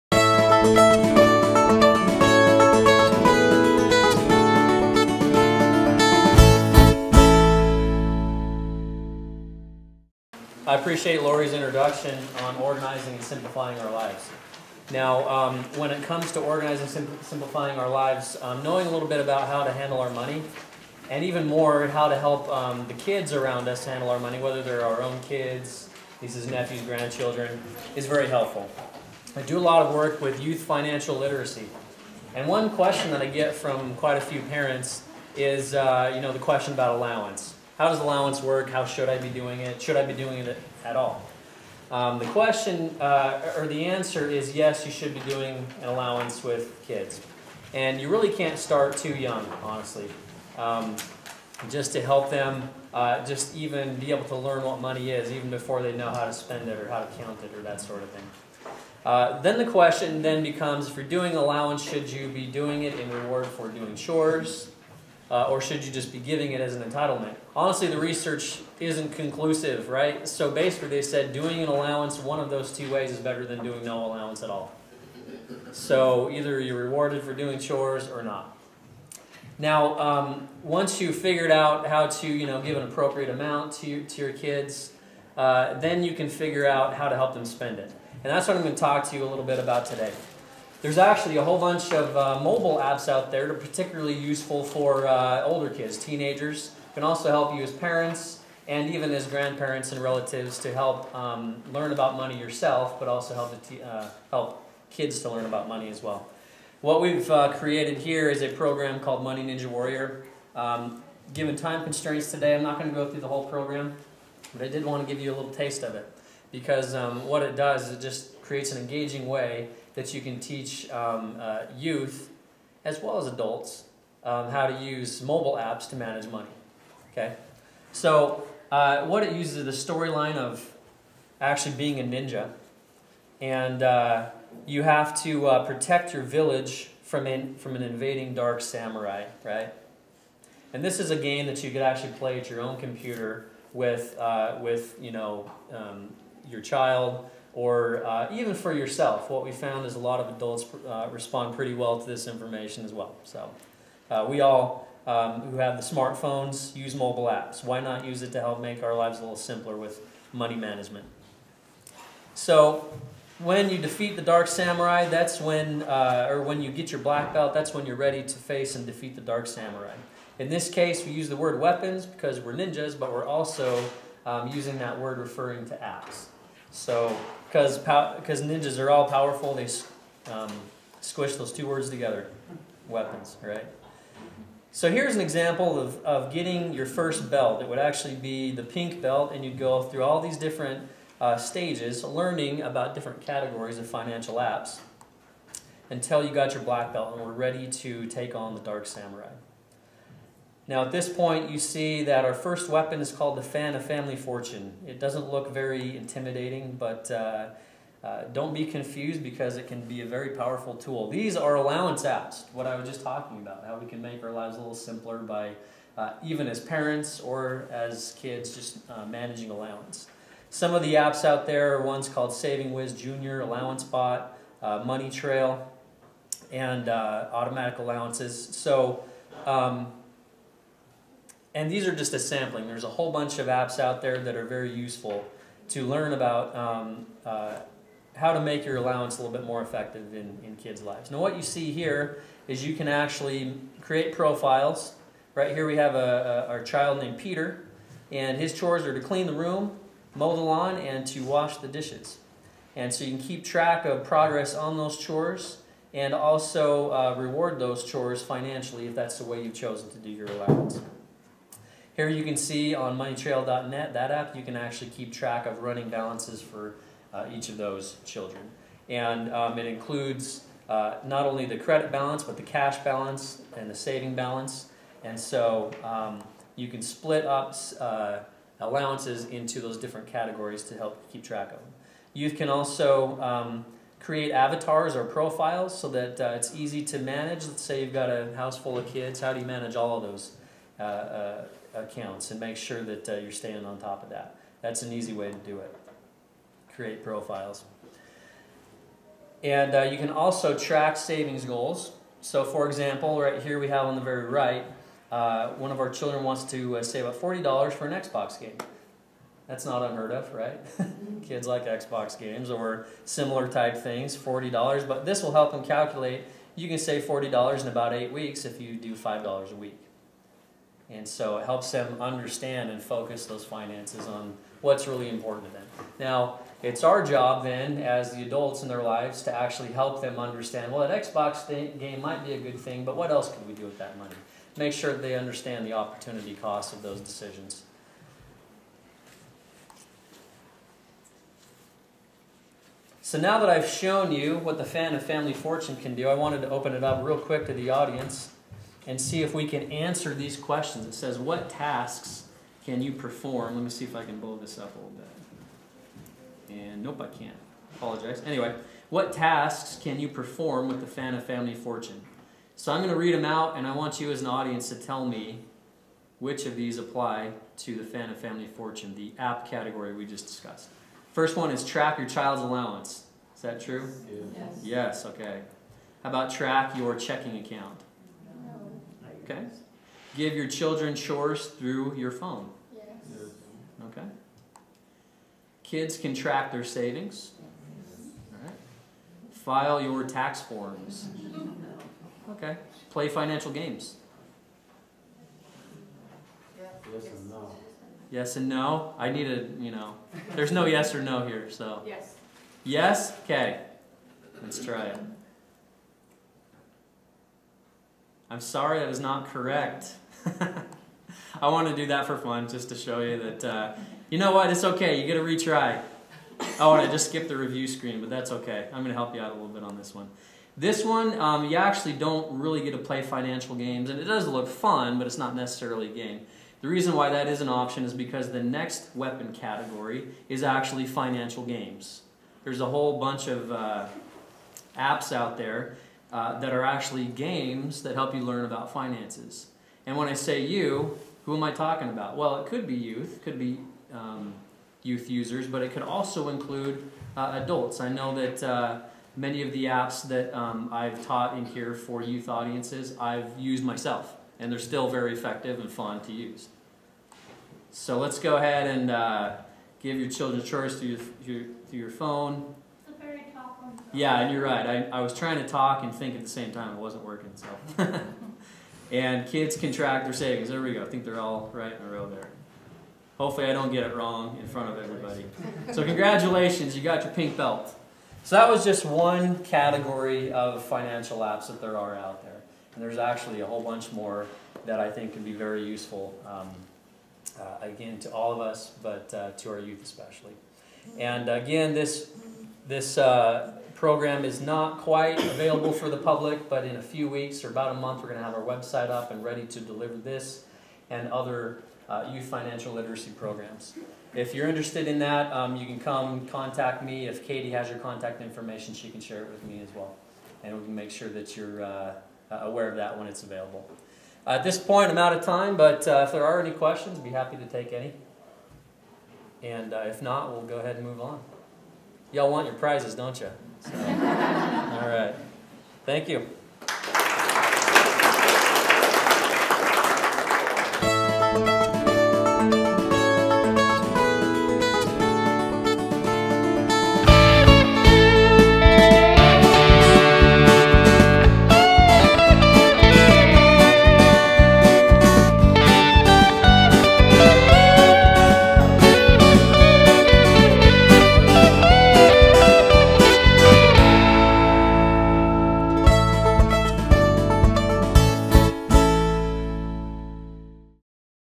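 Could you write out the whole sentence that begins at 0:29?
I do a lot of work with youth financial literacy.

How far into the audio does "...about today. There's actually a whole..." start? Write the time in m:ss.
1:29.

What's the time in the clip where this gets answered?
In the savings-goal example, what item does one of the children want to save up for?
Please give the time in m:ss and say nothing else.
5:07.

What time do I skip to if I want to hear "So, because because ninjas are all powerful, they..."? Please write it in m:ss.
2:56.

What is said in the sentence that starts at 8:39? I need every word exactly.
And uh, if not, we'll go ahead and move on.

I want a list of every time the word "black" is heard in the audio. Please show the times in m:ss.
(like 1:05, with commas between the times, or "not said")
2:47, 3:16.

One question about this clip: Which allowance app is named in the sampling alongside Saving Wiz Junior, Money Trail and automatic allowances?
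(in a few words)
Allowance Bot.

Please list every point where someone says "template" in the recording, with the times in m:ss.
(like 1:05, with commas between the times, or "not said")
not said.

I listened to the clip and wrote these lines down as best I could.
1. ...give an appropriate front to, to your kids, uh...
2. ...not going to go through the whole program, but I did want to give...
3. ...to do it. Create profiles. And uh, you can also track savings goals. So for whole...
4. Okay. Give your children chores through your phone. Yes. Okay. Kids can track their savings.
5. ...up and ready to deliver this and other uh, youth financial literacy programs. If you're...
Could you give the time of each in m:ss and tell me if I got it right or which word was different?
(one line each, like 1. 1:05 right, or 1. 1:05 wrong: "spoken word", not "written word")
1. 1:22 wrong: "amount", not "front"
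2. 1:52 right
3. 4:55 wrong: "example", not "whole"
4. 6:19 right
5. 8:18 right.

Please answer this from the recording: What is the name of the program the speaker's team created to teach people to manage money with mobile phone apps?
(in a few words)
Money Ninja Warrior.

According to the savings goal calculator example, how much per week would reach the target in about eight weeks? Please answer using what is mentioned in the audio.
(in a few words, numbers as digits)
$5.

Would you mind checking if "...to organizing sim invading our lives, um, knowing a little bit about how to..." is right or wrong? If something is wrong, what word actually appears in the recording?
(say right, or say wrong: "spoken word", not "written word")
wrong: "simplifying", not "invading".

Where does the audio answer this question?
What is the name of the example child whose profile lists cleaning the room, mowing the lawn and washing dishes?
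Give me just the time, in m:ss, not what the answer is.
4:07.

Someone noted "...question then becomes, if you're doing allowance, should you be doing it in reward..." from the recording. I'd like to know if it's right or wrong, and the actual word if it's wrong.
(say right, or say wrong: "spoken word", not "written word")
right.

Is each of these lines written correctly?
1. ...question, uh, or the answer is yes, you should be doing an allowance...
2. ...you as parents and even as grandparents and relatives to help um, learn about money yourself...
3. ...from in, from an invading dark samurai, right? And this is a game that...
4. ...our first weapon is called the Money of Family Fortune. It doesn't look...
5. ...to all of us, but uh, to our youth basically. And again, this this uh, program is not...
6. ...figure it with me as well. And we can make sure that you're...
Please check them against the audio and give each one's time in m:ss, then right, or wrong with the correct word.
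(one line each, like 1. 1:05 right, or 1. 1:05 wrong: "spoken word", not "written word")
1. 0:42 right
2. 1:37 right
3. 2:17 right
4. 3:22 wrong: "Fan", not "Money"
5. 8:07 wrong: "especially", not "basically"
6. 8:29 wrong: "share", not "figure".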